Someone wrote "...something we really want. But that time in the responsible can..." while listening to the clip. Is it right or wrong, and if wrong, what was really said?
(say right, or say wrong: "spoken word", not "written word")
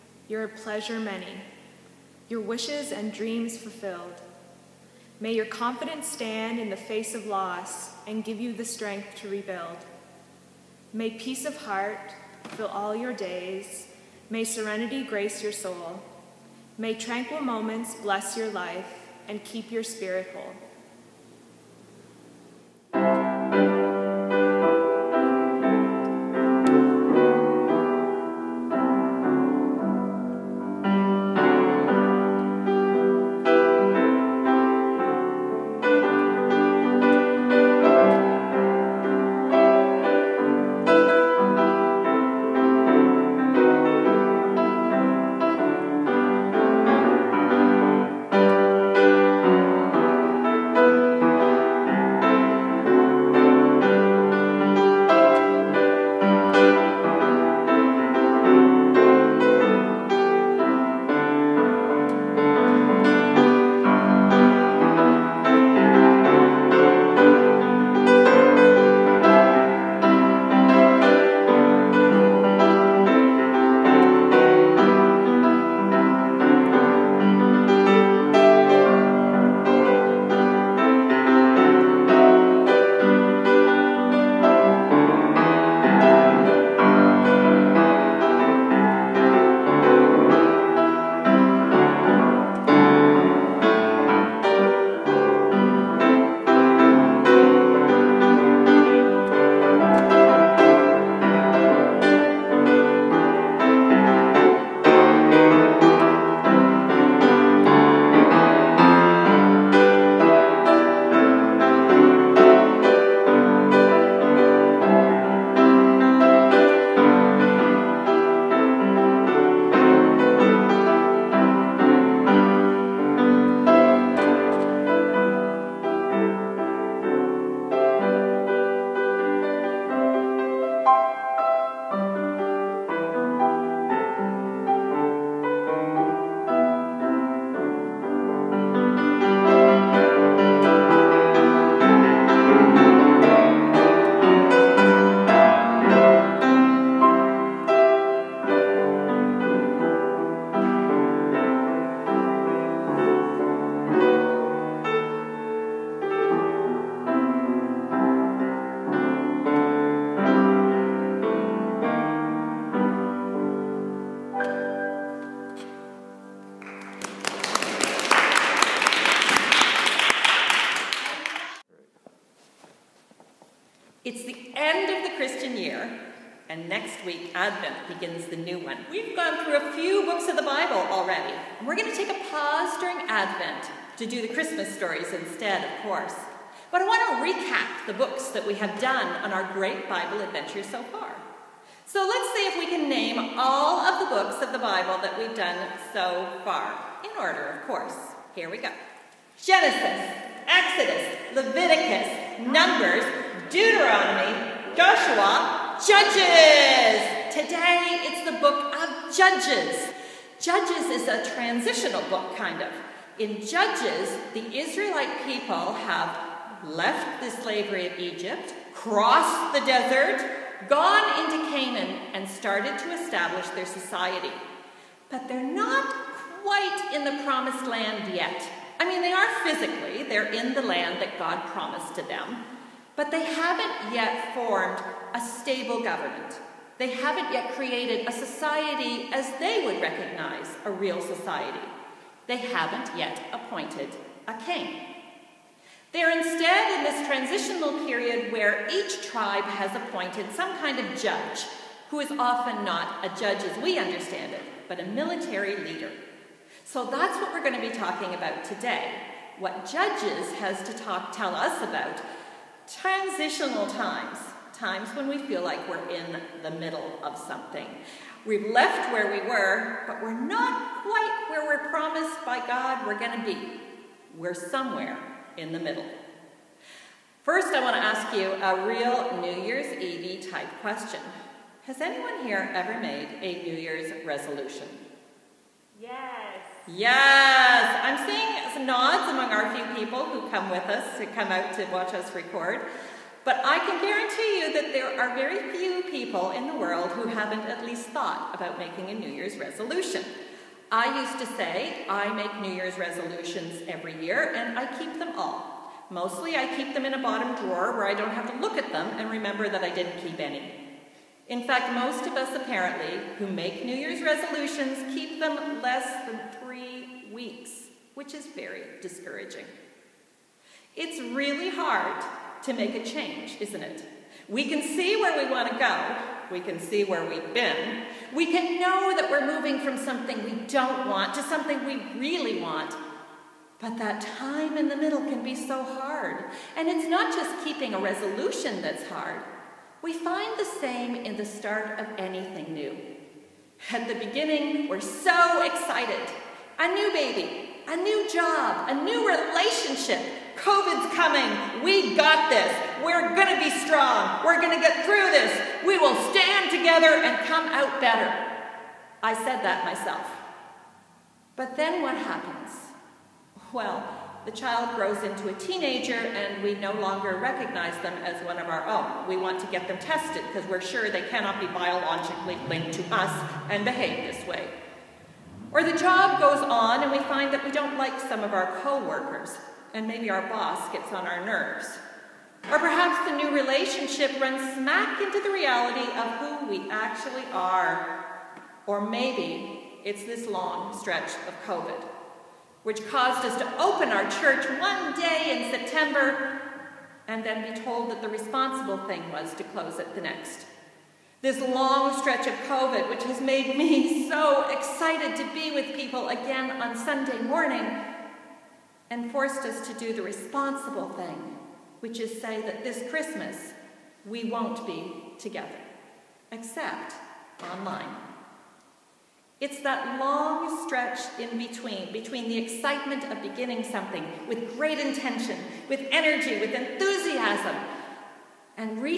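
wrong: "middle", not "responsible".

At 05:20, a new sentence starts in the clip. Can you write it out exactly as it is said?
It's really hard to make a change, isn't it?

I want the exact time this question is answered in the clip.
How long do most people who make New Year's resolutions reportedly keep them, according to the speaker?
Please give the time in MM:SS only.
05:15.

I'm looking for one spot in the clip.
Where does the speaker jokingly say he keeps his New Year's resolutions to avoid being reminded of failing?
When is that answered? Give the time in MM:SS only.
05:06.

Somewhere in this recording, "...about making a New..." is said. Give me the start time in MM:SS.
04:58.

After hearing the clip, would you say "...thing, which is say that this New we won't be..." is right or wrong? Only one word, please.
wrong.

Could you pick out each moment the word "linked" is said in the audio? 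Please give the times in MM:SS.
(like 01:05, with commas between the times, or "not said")
06:12.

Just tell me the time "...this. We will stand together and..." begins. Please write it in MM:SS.
05:55.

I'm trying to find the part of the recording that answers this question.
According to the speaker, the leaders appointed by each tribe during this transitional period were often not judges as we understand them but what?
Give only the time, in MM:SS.
04:14.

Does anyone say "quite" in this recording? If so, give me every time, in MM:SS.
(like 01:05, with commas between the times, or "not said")
03:46, 04:30.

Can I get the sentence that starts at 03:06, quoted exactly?
But I want to recap the books that we have done on our great Bible adventure so far.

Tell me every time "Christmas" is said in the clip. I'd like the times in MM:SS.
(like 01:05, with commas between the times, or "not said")
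03:04, 06:52.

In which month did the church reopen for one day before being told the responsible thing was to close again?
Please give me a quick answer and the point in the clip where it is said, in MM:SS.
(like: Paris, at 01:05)
September, at 06:35.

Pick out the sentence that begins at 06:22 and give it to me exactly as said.
Or perhaps the new relationship runs smack into the reality of who we actually are.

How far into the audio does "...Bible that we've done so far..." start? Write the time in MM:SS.
03:14.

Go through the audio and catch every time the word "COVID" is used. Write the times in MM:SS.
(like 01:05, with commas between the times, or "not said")
05:50, 06:31, 06:42.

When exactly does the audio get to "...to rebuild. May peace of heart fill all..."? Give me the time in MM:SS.
00:09.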